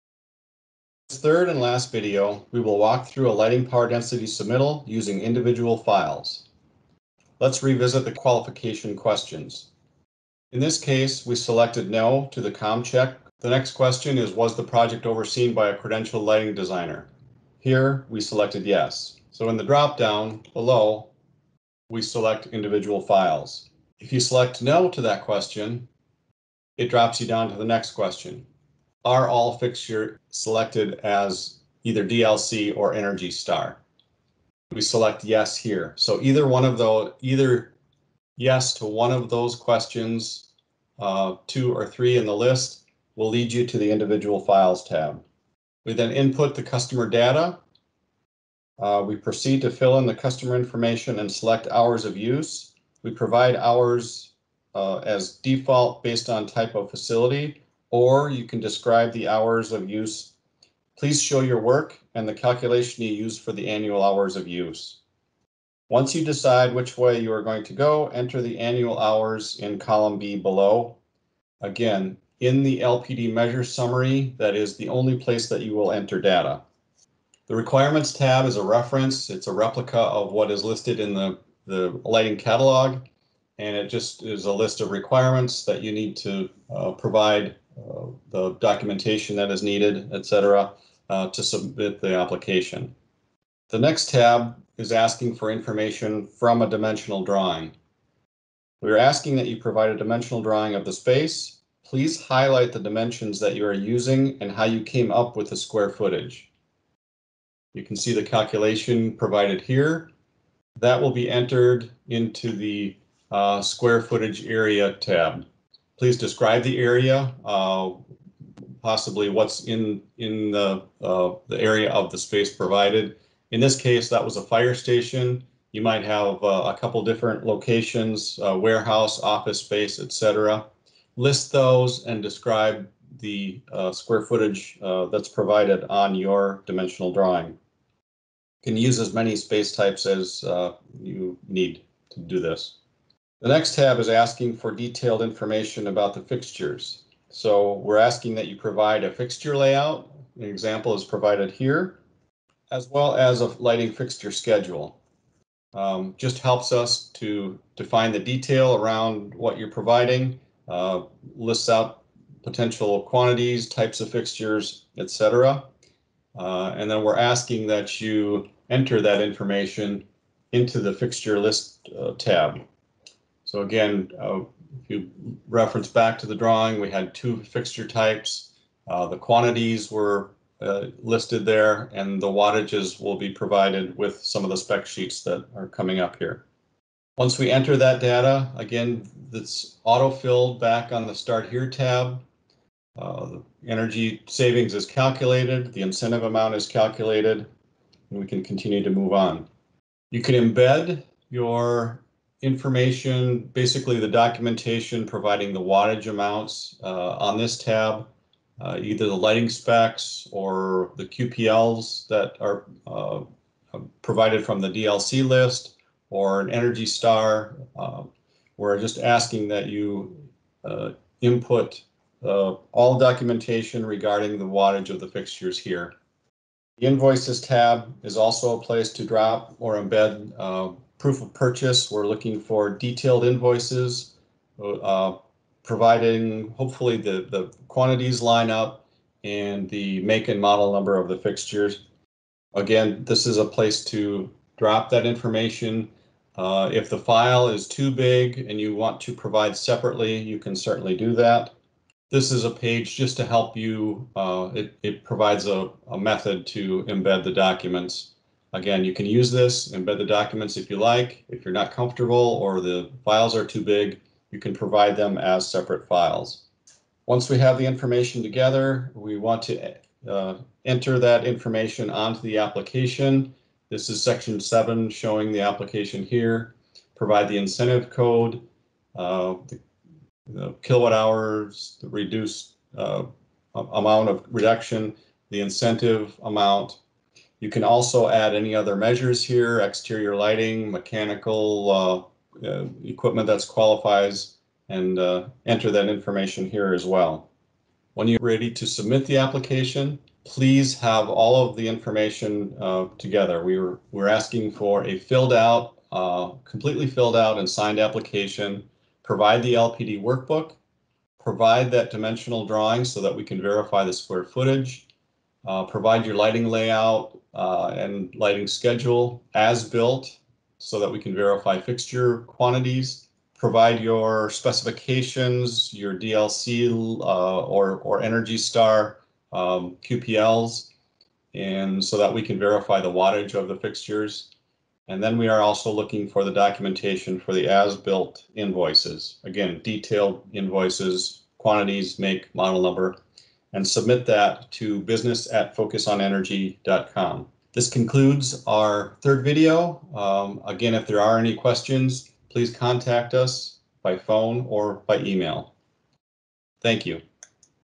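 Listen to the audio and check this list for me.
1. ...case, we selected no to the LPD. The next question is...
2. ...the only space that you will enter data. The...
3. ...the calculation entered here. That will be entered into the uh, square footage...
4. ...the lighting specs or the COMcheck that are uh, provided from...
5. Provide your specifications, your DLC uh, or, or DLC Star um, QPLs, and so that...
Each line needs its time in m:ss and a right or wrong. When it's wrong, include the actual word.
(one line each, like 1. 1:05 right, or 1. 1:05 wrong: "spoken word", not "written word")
1. 0:10 wrong: "COMcheck", not "LPD"
2. 1:14 wrong: "place", not "space"
3. 1:48 wrong: "provided", not "entered"
4. 3:29 wrong: "QPLs", not "COMcheck"
5. 5:23 wrong: "Energy", not "DLC".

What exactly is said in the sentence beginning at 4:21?
If you're not comfortable or the files are too big, you can provide them as separate files.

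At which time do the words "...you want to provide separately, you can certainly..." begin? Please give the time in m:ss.
4:08.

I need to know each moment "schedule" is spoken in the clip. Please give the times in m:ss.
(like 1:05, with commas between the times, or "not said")
2:34, 5:18.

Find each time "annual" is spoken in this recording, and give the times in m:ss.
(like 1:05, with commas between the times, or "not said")
1:03, 1:08.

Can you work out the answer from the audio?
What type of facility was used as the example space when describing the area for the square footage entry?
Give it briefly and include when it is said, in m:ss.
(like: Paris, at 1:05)
Fire station, at 2:04.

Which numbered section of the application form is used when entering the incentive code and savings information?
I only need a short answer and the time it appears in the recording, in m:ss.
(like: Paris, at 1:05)
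Section 7, at 4:34.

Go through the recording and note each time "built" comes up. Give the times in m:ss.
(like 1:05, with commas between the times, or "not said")
5:19, 5:37.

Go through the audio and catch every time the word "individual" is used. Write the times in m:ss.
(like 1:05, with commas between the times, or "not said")
0:05, 0:22, 0:43.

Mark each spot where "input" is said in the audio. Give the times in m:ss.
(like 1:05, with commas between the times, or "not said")
0:46, 3:41.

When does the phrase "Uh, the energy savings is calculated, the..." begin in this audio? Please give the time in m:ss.
3:12.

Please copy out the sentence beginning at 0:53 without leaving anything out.
We provide hours uh, as default based on type of facility or you can describe the hours of use.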